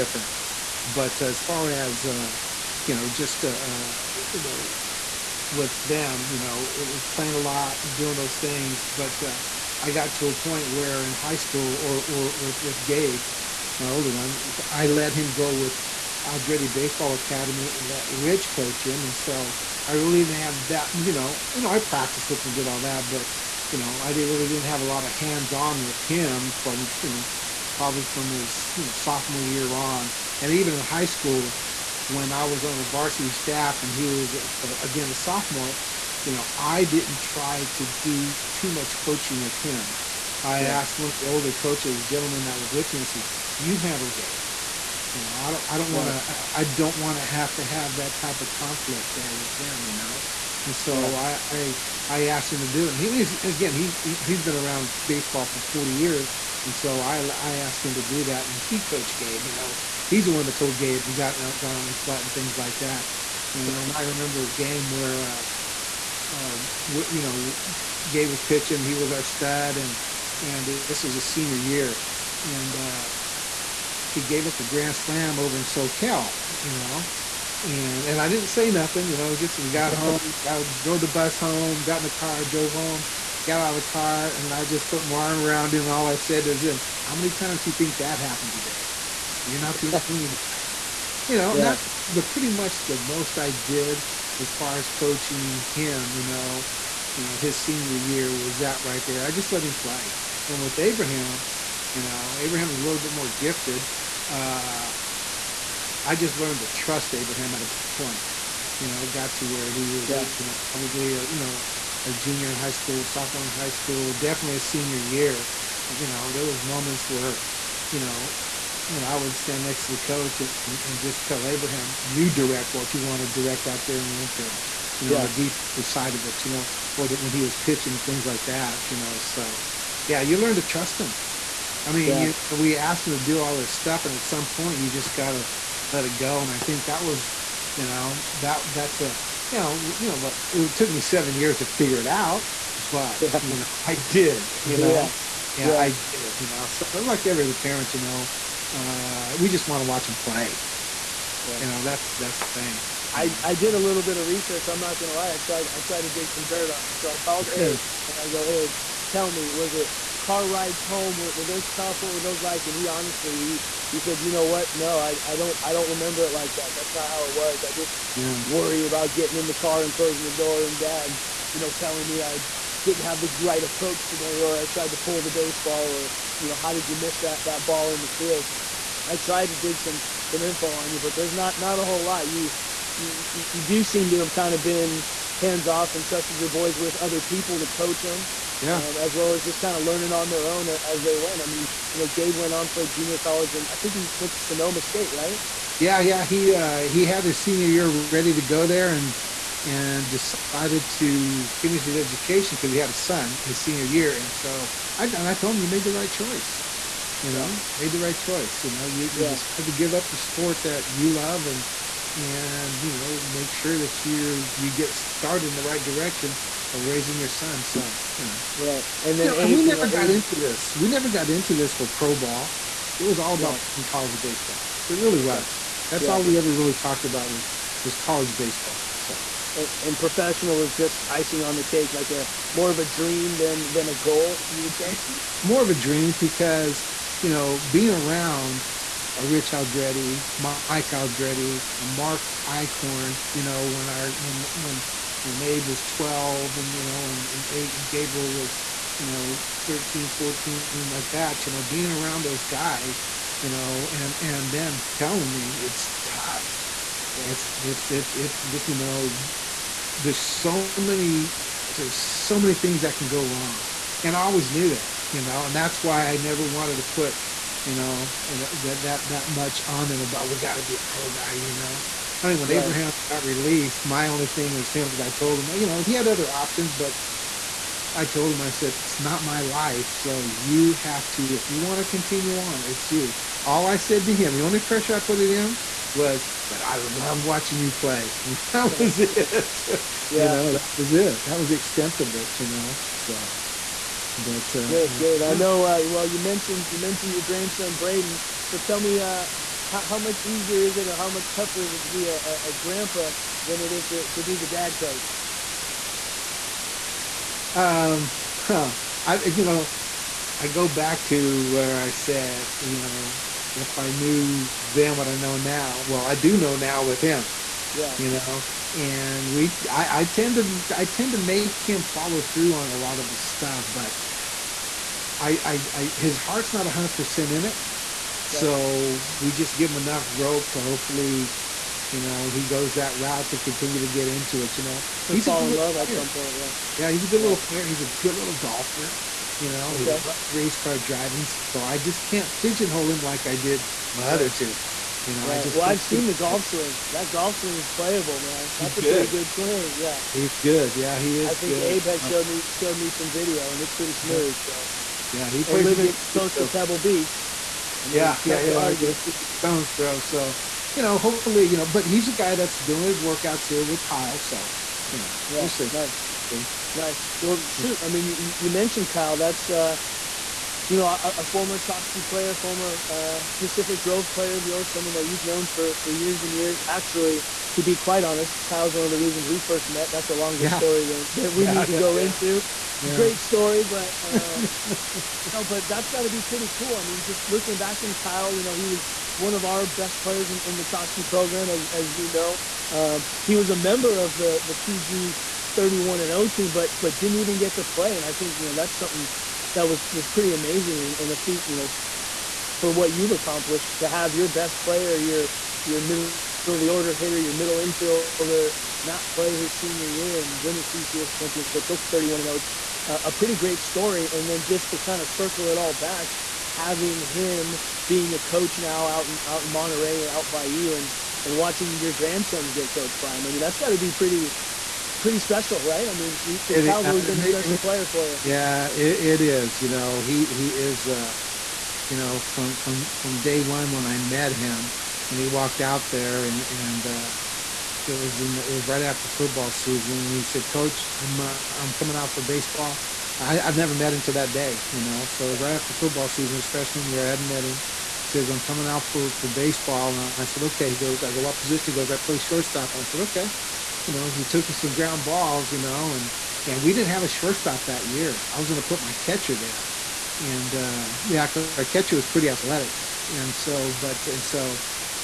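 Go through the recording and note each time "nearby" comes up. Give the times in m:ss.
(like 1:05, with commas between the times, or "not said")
not said.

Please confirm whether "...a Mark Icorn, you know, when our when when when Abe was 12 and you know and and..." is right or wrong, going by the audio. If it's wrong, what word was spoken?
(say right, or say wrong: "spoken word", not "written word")
right.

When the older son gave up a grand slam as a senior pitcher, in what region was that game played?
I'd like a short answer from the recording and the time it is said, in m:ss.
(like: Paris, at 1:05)
SoCal, at 1:15.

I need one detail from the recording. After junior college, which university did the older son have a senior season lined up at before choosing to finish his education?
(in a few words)
Sonoma State.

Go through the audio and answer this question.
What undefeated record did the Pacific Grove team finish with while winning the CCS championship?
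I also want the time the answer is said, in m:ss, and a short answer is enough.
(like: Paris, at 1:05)
31-0, at 6:51.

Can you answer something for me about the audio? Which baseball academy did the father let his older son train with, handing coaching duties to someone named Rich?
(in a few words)
Aldrete Baseball Academy.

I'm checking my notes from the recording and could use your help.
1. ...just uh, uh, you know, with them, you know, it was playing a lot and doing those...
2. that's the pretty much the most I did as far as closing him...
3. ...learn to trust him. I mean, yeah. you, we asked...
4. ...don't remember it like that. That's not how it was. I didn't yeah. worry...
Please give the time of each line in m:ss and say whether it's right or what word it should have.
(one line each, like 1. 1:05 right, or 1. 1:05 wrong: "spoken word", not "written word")
1. 0:03 right
2. 1:31 wrong: "coaching", not "closing"
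3. 2:10 right
4. 2:45 right.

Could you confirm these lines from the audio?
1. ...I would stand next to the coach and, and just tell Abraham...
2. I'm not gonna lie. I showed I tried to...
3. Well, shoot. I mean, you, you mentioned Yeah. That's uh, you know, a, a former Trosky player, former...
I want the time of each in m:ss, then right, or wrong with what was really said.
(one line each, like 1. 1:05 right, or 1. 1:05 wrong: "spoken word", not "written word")
1. 1:59 right
2. 2:34 wrong: "tried", not "showed"
3. 6:07 wrong: "Kyle", not "Yeah".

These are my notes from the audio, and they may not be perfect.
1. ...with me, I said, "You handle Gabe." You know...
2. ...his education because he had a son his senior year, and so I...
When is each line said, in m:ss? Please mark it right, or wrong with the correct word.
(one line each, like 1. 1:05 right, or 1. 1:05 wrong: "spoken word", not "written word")
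1. 0:42 right
2. 3:21 right.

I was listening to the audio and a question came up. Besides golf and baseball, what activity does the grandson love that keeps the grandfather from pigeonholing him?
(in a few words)
race car driving.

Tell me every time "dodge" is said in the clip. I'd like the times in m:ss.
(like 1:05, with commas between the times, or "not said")
not said.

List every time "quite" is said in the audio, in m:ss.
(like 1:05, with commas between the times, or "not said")
6:17.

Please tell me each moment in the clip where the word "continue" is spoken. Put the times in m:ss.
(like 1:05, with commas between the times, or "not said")
4:41, 5:33.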